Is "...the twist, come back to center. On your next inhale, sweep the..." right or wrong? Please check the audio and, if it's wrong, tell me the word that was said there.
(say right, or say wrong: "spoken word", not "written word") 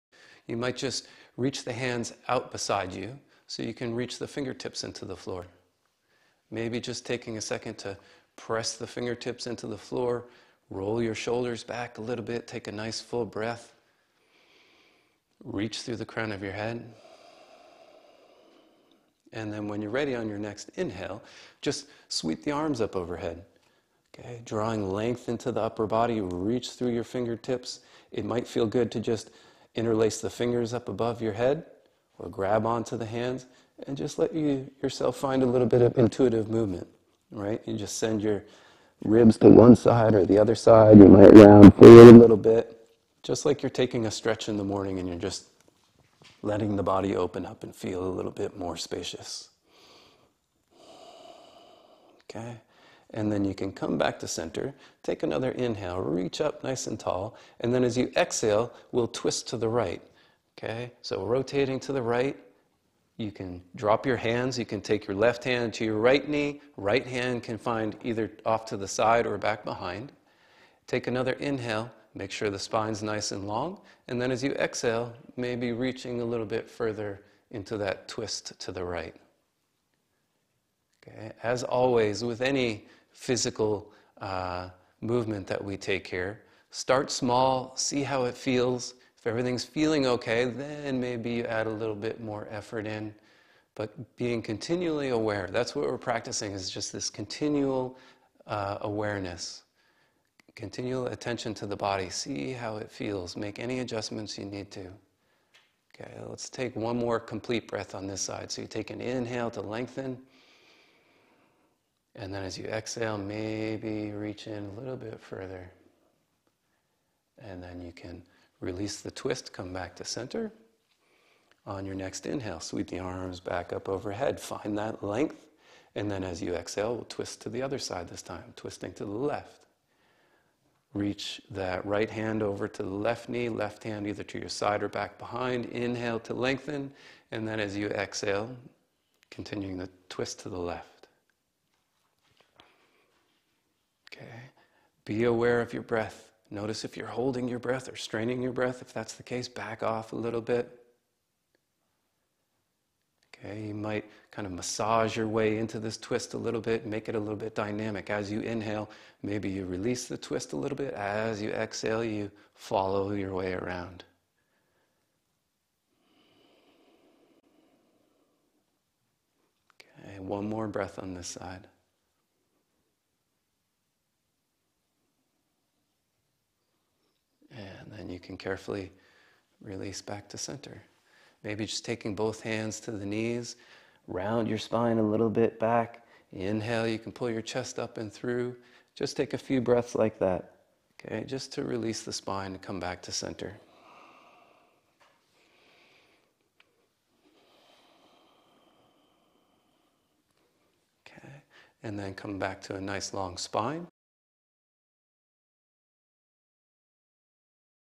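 right.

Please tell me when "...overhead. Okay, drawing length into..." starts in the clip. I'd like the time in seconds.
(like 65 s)
22 s.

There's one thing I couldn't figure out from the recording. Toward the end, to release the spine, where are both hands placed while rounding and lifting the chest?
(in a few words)
The knees.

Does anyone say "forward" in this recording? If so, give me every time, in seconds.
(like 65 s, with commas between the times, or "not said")
41 s.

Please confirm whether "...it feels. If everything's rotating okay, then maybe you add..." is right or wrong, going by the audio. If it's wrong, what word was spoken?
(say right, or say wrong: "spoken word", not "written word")
wrong: "feeling", not "rotating".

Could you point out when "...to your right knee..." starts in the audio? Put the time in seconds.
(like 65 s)
65 s.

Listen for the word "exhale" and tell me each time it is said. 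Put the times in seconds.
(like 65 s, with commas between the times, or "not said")
58 s, 74 s, 112 s, 126 s, 137 s, 161 s.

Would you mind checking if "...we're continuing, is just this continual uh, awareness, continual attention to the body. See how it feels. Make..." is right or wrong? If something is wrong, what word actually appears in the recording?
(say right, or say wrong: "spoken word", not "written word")
wrong: "practicing", not "continuing".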